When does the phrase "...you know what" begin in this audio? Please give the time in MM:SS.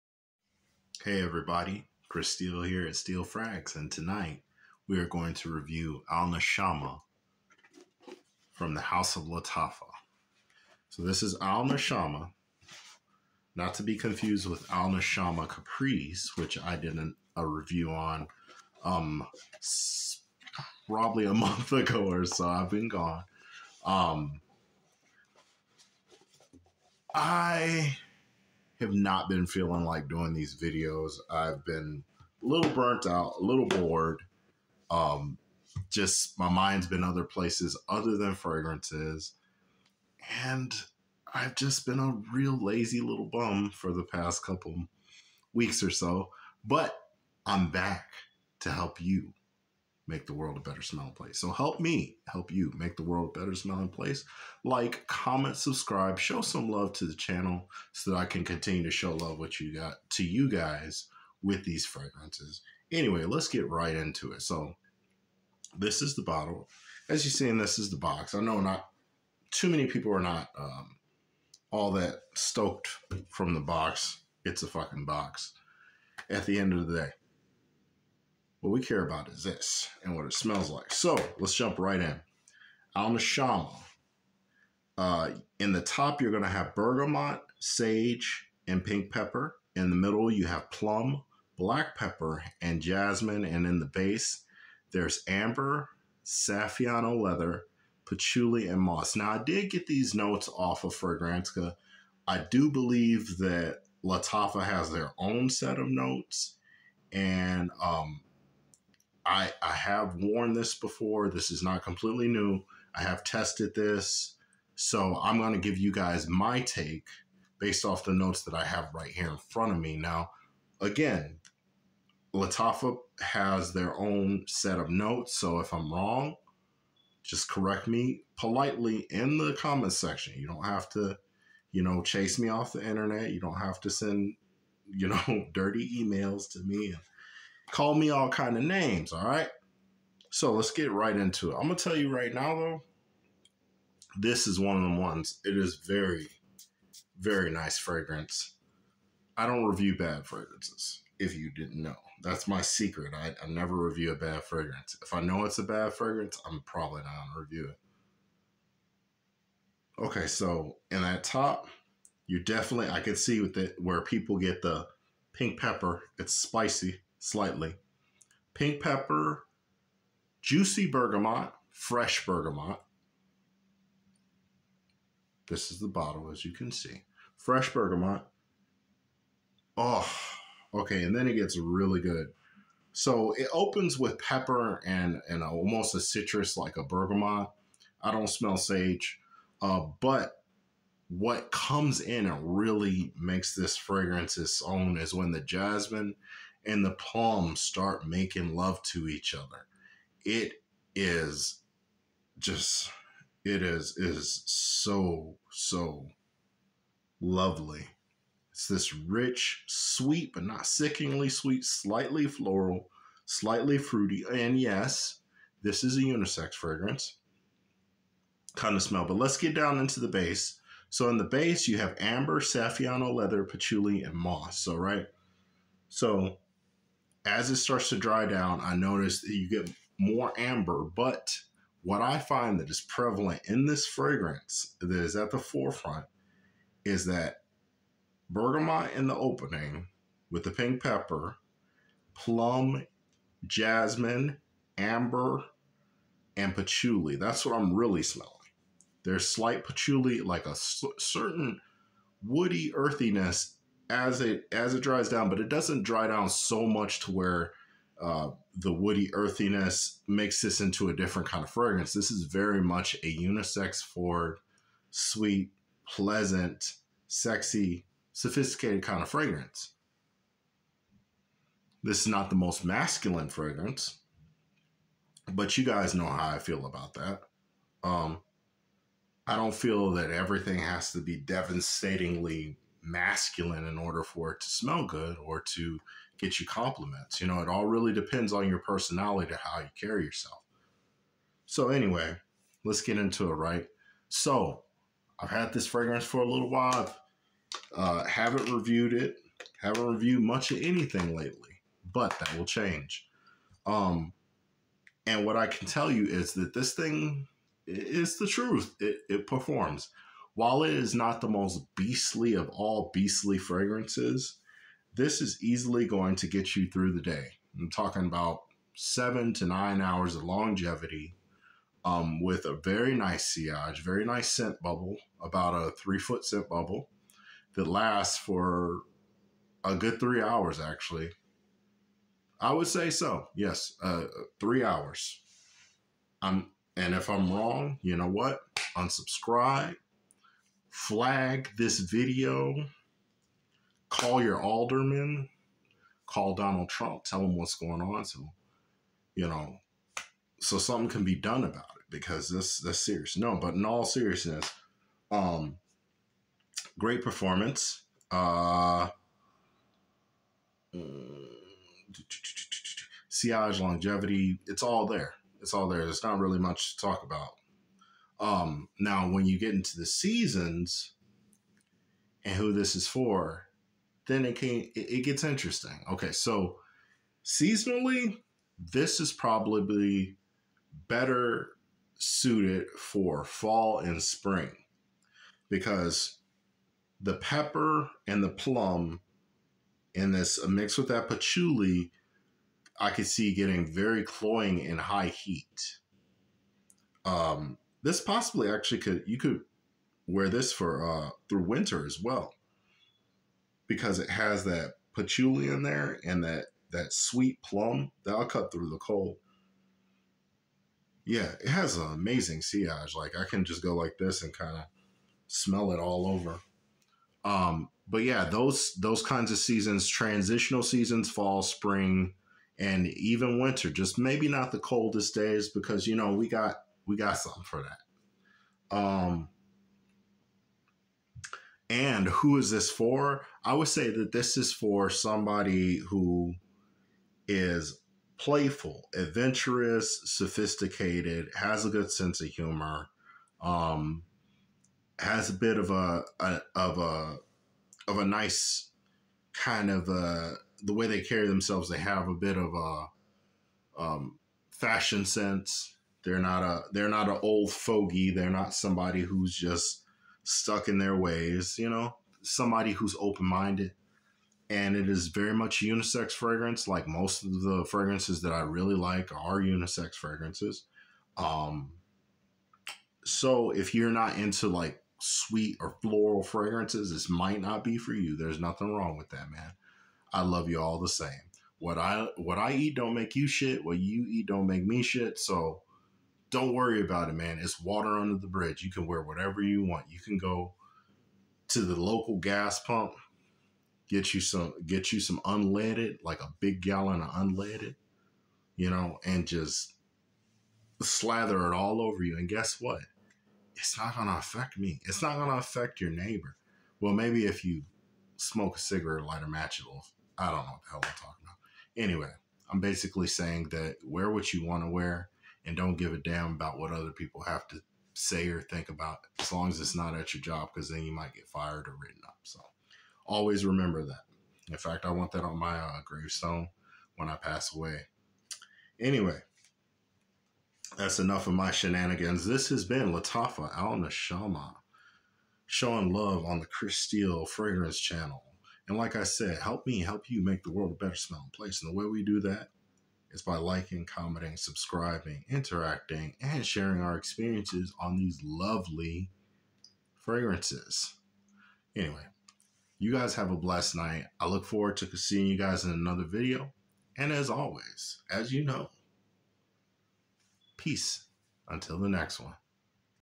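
05:37.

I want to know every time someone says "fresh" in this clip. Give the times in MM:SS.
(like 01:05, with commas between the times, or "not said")
02:51, 02:57.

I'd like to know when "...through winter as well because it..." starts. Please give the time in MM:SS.
06:41.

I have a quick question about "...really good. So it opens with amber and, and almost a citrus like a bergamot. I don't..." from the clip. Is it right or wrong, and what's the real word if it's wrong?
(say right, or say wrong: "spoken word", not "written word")
wrong: "pepper", not "amber".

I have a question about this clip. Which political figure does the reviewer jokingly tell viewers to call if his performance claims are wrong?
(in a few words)
Donald Trump.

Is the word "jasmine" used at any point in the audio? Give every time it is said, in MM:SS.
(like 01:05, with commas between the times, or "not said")
01:32, 03:15, 04:03.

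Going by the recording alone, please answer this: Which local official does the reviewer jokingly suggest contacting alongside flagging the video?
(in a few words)
alderman.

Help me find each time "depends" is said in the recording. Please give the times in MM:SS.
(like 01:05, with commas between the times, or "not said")
04:47.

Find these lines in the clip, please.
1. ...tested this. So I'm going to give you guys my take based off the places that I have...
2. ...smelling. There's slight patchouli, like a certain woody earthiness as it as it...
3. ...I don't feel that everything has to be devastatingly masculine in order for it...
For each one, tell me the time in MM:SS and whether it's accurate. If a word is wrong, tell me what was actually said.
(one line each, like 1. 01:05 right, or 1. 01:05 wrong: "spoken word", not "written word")
1. 01:53 wrong: "notes", not "places"
2. 04:08 right
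3. 04:39 right.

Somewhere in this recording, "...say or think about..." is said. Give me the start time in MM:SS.
08:37.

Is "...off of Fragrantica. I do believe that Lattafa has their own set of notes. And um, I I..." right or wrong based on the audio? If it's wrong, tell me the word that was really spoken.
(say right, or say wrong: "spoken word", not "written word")
right.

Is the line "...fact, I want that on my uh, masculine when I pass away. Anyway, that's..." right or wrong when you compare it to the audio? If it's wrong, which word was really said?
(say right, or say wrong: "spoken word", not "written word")
wrong: "gravestone", not "masculine".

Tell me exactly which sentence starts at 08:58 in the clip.
And like I said, help me help you make the world a better smelling place.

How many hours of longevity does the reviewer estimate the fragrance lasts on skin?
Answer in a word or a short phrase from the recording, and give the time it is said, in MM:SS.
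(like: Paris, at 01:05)
7 to 9 hours, at 05:18.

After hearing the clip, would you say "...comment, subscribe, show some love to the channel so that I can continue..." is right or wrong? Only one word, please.
right.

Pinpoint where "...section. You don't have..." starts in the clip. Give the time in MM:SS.
02:09.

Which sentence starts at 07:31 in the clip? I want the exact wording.
They have a bit of a um, fashion sense.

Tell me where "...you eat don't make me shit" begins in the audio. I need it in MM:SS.
08:03.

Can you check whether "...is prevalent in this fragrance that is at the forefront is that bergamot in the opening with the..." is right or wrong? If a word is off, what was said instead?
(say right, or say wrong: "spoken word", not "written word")
right.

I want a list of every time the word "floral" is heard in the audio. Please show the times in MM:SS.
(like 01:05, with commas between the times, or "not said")
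03:32, 07:55.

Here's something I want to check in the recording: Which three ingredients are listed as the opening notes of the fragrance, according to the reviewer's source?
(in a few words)
bergamot, sage, and pink pepper.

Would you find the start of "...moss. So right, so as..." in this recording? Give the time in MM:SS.
03:44.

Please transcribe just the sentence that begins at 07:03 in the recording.
Just maybe not the coldest days because you know we got we got something for that.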